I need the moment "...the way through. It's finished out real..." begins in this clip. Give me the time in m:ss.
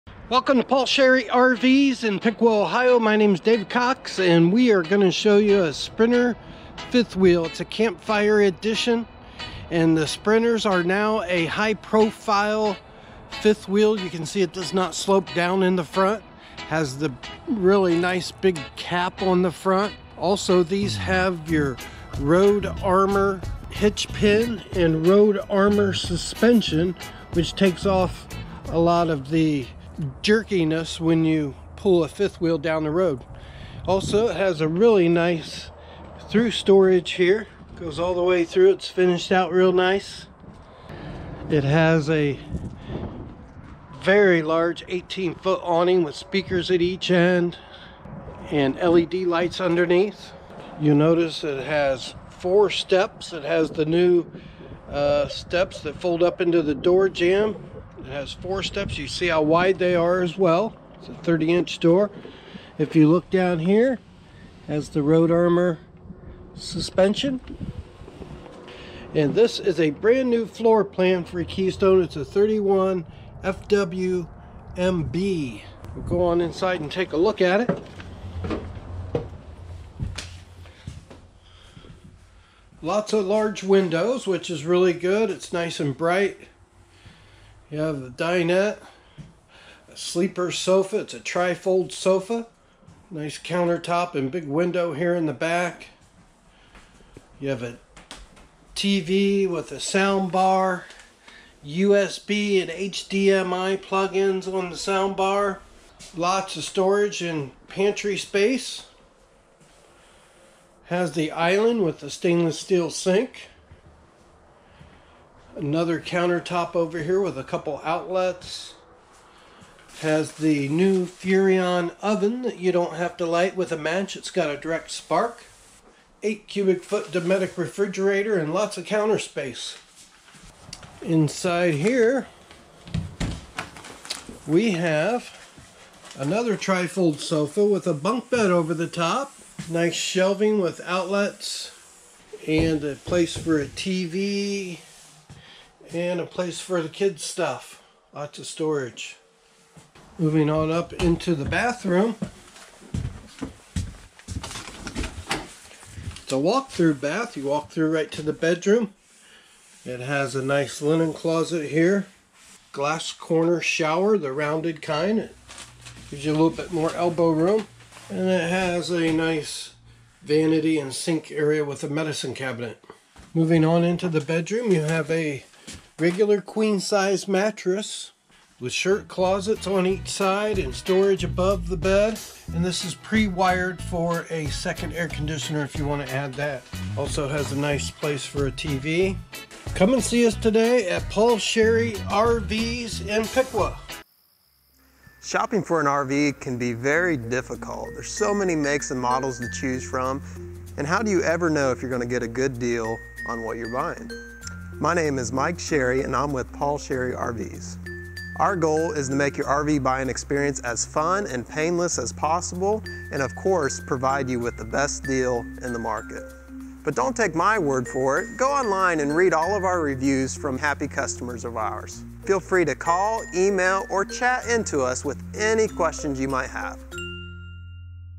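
0:38.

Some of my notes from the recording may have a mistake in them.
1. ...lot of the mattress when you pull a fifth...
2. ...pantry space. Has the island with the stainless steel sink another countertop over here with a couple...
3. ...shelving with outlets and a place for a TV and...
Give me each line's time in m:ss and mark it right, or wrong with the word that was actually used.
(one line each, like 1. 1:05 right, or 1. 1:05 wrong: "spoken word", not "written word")
1. 0:28 wrong: "jerkiness", not "mattress"
2. 1:47 right
3. 2:19 right.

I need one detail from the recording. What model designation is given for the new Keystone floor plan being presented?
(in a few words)
31 FWMB.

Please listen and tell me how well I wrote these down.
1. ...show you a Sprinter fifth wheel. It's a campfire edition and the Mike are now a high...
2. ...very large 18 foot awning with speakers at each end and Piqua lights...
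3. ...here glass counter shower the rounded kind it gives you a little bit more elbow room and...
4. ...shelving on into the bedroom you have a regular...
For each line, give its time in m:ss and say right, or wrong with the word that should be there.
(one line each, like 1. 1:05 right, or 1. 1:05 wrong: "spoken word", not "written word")
1. 0:05 wrong: "Sprinters", not "Mike"
2. 0:44 wrong: "LED", not "Piqua"
3. 2:41 wrong: "corner", not "counter"
4. 2:53 wrong: "moving", not "shelving".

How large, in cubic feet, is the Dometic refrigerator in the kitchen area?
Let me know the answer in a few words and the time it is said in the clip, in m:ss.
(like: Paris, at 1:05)
8 cubic feet, at 2:06.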